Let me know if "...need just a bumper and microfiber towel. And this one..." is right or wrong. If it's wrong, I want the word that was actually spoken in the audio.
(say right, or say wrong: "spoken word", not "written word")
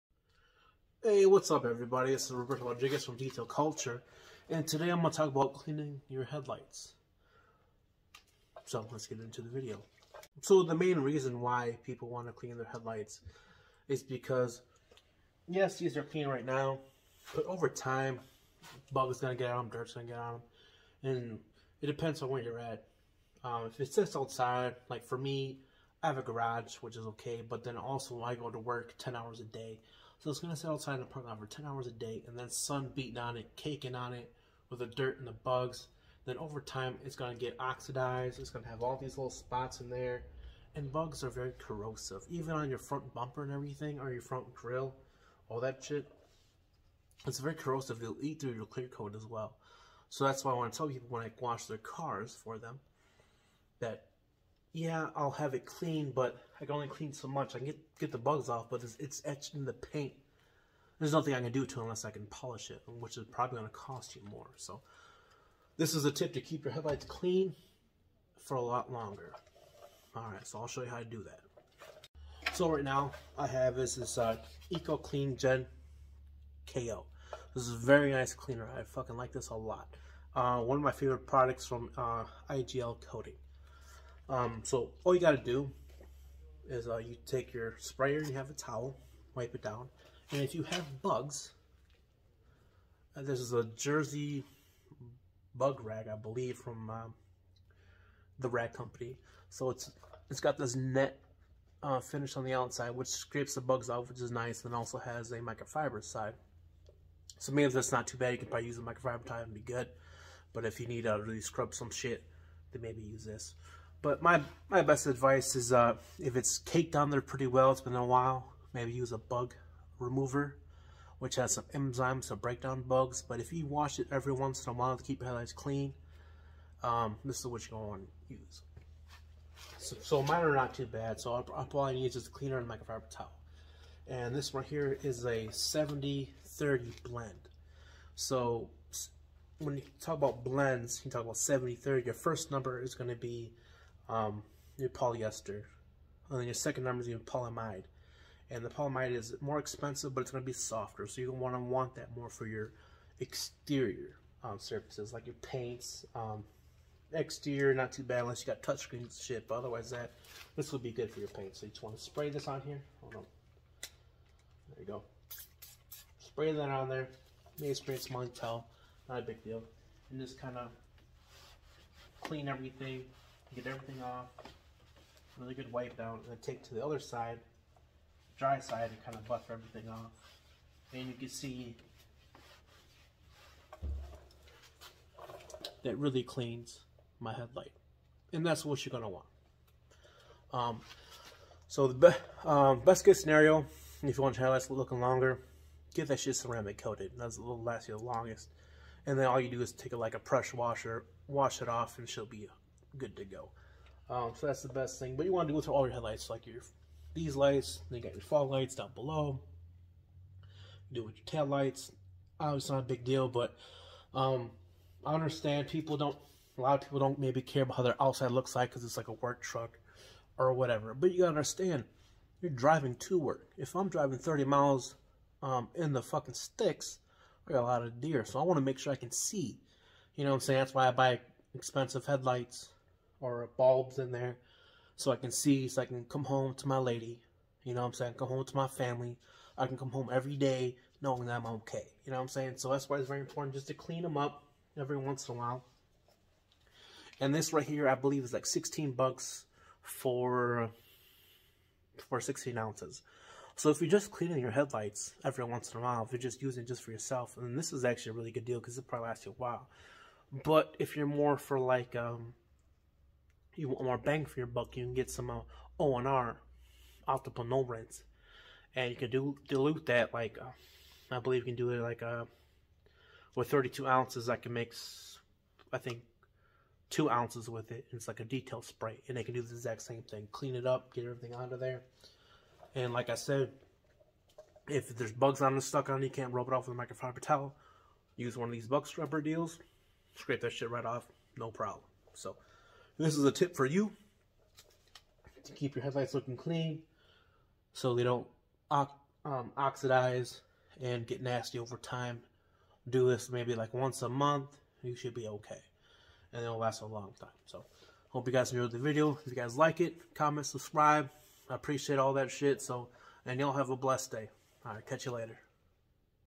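wrong: "cleaner", not "bumper".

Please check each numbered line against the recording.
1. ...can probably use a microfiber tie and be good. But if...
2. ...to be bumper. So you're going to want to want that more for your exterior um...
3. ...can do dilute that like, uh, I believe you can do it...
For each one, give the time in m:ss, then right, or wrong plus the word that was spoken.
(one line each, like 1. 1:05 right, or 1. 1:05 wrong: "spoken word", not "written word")
1. 1:48 right
2. 2:30 wrong: "softer", not "bumper"
3. 4:28 right.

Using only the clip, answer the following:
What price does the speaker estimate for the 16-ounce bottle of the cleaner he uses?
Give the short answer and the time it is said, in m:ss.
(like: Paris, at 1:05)
$16, at 4:08.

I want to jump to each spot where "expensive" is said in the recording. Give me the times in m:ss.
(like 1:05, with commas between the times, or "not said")
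2:29, 3:51.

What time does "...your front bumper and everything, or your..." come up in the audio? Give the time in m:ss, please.
0:42.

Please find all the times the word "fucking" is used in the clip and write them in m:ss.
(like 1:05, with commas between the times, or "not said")
1:18, 3:46.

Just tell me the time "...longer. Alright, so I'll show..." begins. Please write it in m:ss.
1:08.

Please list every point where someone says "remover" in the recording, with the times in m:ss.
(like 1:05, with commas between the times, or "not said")
1:59.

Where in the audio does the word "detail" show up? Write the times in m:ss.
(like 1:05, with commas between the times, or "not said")
0:03, 4:38.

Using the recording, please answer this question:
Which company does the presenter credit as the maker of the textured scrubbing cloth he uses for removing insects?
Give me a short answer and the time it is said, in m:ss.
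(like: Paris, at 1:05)
The Rag Company, at 1:38.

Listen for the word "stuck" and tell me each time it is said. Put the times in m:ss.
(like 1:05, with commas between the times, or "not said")
4:45.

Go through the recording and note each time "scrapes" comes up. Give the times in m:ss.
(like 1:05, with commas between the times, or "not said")
1:43, 4:50.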